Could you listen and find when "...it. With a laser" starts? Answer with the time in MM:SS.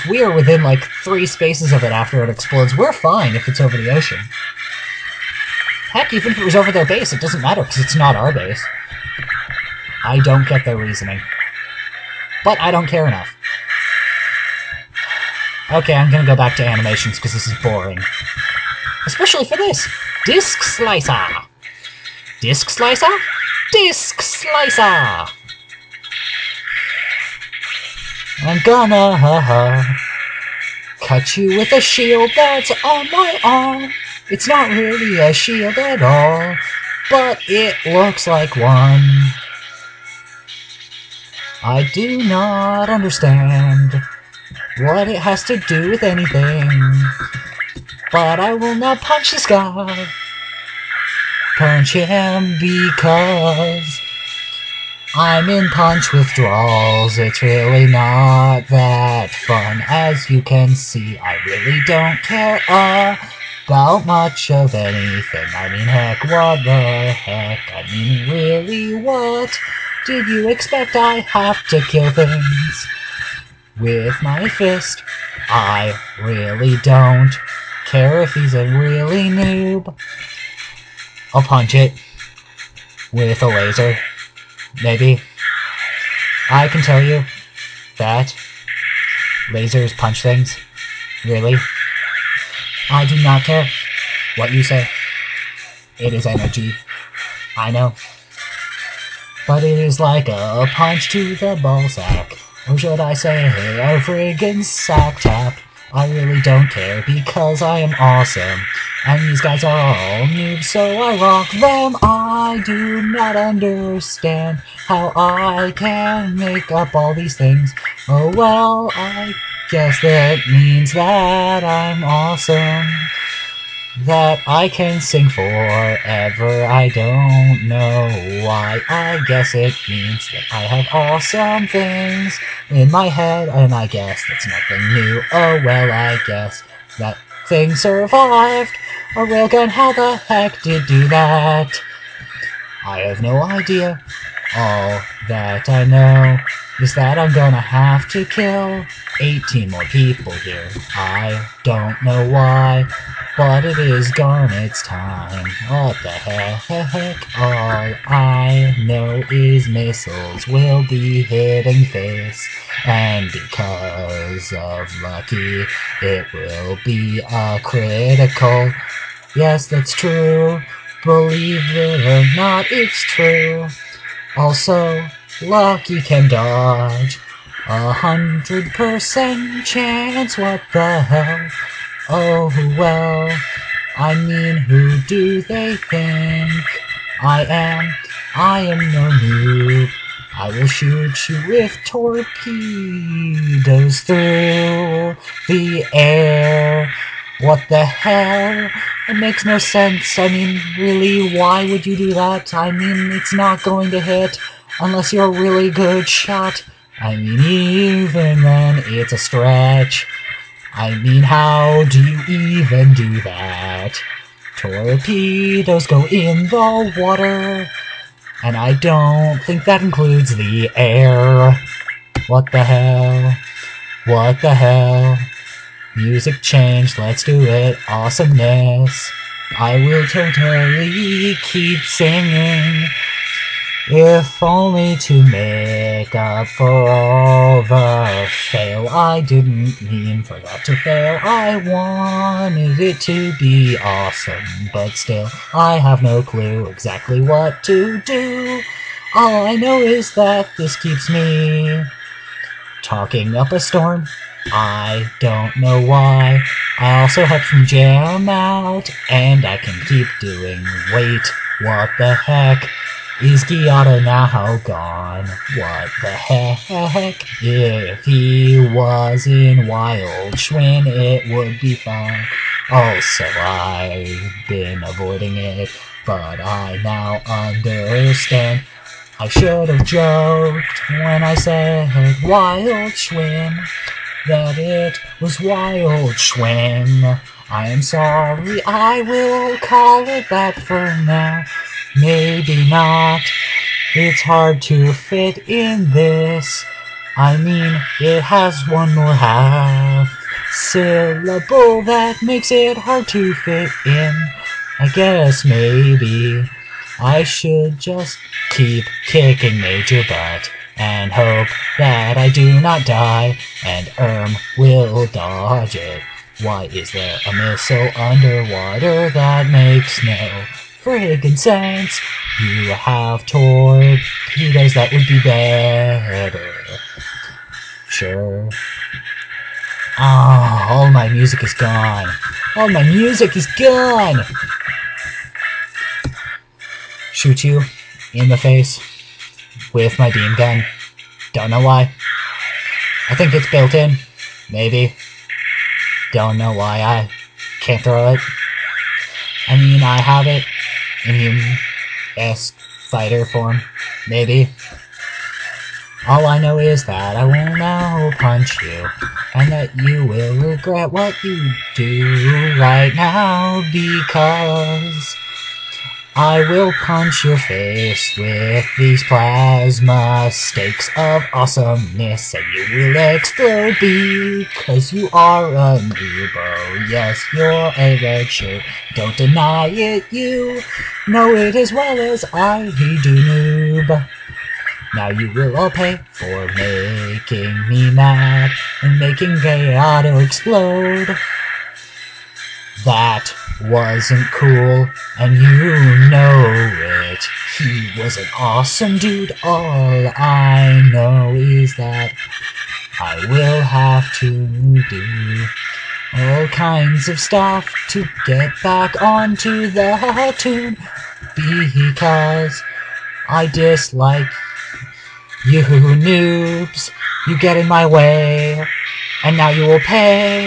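01:21.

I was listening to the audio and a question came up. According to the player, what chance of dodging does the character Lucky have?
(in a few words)
100 percent.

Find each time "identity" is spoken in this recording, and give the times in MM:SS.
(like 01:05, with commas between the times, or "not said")
not said.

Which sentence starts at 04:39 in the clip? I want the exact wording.
I should have joked when I said Wild Schwinn that it was Wild Schwinn.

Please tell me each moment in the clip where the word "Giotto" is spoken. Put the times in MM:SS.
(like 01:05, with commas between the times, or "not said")
04:23.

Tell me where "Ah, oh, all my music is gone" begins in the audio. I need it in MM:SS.
05:29.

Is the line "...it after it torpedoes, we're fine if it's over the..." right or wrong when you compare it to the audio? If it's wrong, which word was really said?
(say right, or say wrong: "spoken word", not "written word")
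wrong: "explodes", not "torpedoes".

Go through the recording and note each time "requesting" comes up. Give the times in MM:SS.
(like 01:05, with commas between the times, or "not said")
not said.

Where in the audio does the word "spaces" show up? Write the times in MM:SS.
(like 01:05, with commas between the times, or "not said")
00:01.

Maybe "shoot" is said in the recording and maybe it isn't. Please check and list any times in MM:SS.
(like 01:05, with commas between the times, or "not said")
03:10, 05:37.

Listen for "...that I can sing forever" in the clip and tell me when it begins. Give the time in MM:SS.
02:04.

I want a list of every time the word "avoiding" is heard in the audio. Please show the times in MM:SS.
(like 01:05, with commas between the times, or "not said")
04:34.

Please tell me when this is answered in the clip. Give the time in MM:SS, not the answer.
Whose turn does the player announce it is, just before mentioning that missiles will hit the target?
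02:34.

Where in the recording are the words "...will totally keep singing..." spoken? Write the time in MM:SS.
03:49.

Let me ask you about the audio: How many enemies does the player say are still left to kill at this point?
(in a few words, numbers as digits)
18.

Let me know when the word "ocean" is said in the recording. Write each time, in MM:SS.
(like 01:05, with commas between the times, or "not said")
00:03.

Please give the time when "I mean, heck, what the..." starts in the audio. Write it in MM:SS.
01:05.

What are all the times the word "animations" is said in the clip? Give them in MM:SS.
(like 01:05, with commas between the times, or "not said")
00:16.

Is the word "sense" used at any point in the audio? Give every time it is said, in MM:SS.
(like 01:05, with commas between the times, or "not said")
03:19, 05:21.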